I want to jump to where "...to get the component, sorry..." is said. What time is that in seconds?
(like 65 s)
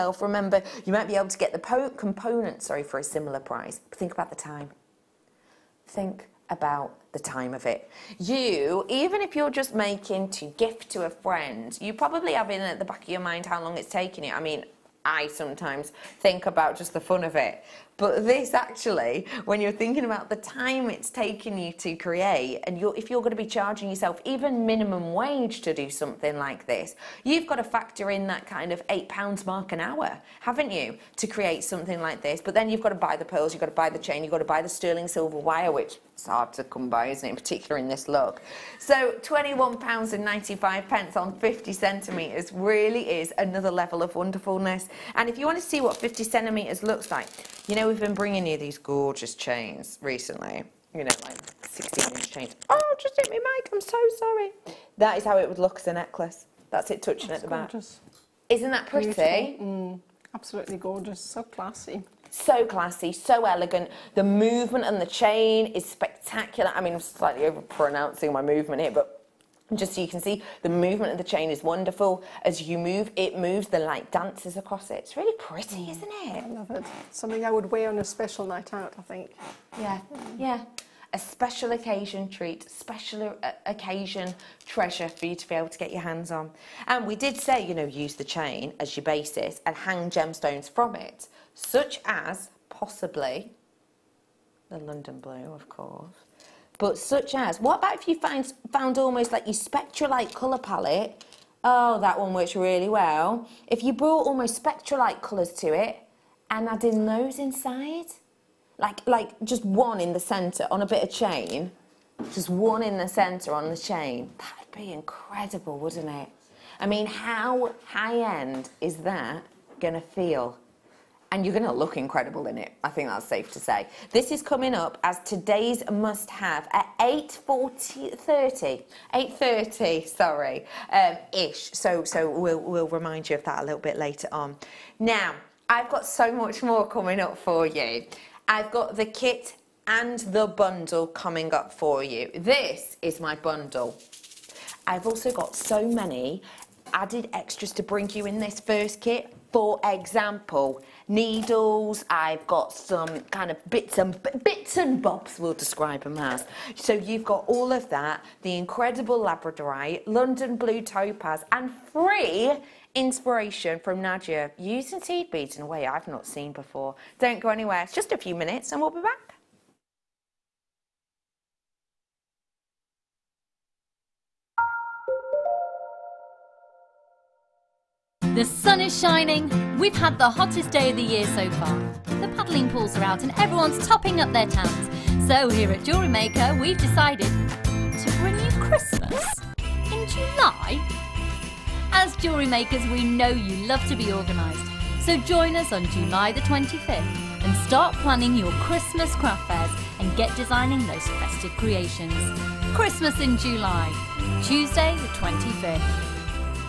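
1 s.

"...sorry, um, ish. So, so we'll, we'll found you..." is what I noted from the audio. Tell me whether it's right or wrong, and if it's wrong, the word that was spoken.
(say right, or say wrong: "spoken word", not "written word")
wrong: "remind", not "found".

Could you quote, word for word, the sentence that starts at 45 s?
And if you want to see what 50 centimetres looks like, you know, we've been bringing you these gorgeous chains recently.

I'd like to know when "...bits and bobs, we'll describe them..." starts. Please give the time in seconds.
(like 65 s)
154 s.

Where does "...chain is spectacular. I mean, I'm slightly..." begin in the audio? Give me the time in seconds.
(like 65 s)
65 s.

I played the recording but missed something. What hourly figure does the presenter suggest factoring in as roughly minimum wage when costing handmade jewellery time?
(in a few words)
£8.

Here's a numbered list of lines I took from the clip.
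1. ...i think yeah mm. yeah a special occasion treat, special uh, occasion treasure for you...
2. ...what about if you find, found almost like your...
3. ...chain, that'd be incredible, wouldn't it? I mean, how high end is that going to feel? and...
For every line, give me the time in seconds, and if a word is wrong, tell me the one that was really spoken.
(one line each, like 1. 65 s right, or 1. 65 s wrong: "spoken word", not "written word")
1. 78 s right
2. 97 s right
3. 113 s right.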